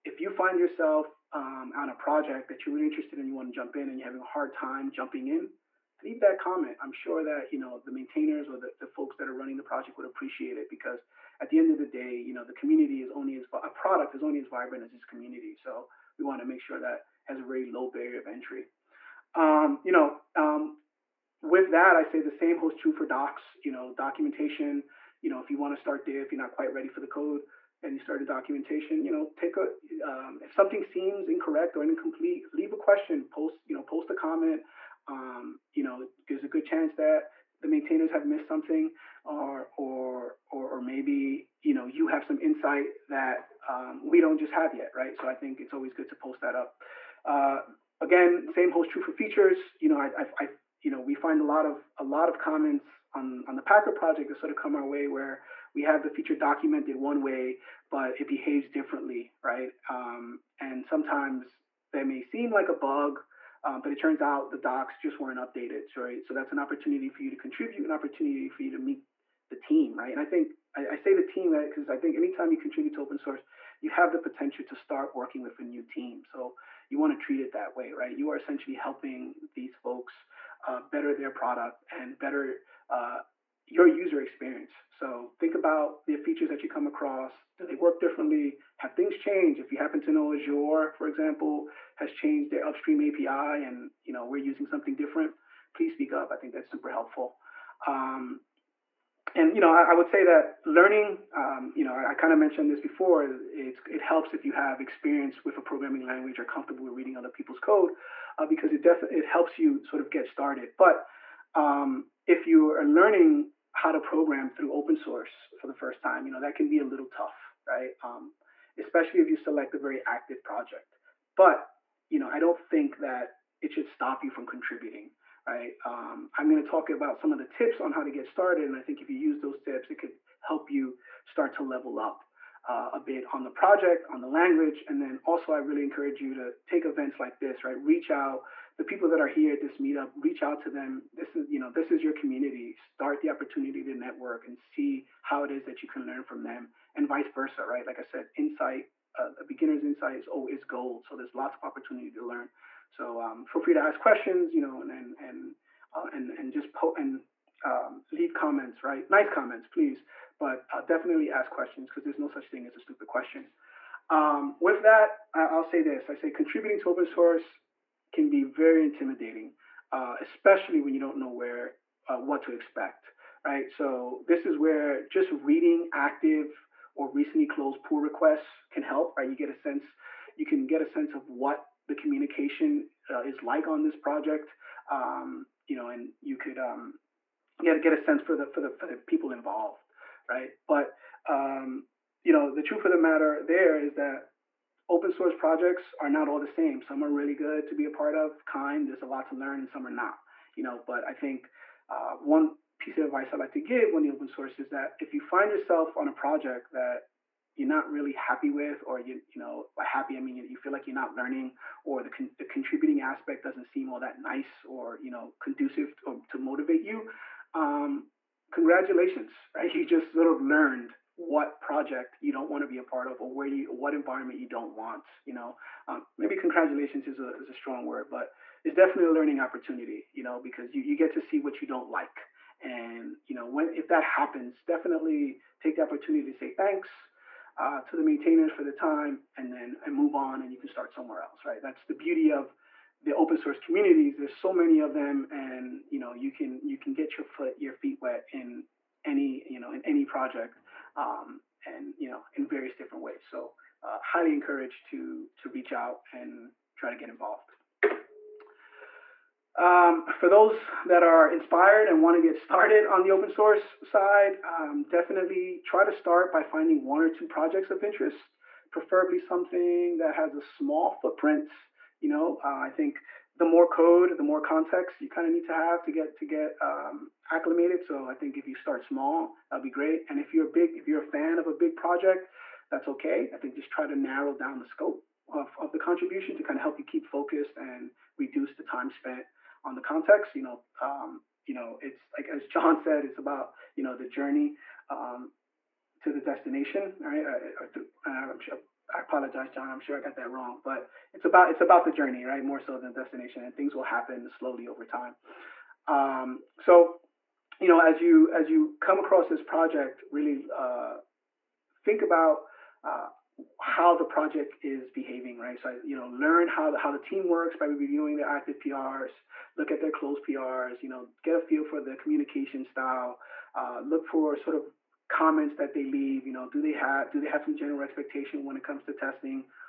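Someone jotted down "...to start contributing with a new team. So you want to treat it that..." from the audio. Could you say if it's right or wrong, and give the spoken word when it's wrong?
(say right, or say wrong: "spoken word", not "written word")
wrong: "working", not "contributing".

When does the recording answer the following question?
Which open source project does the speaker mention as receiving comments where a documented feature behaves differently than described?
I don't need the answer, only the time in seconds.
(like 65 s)
53 s.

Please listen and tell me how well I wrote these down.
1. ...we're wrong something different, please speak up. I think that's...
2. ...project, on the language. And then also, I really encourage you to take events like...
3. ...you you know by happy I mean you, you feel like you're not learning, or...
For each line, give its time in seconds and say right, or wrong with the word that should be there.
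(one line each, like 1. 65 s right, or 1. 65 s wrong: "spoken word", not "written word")
1. 94 s wrong: "using", not "wrong"
2. 133 s right
3. 208 s right.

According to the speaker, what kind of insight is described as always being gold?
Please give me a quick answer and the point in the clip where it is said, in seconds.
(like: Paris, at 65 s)
A beginner's insight, at 149 s.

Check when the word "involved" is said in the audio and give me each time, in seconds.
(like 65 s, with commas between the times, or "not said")
189 s, 257 s.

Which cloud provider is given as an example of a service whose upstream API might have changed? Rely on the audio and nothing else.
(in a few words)
Azure.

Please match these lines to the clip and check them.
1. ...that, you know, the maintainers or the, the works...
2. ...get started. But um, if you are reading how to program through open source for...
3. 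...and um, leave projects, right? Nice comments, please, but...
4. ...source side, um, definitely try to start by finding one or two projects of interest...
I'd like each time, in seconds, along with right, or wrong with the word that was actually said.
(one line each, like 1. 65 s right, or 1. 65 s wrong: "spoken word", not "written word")
1. 7 s wrong: "folks", not "works"
2. 110 s wrong: "learning", not "reading"
3. 156 s wrong: "comments", not "projects"
4. 263 s right.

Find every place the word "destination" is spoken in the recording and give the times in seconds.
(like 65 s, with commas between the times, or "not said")
296 s, 302 s.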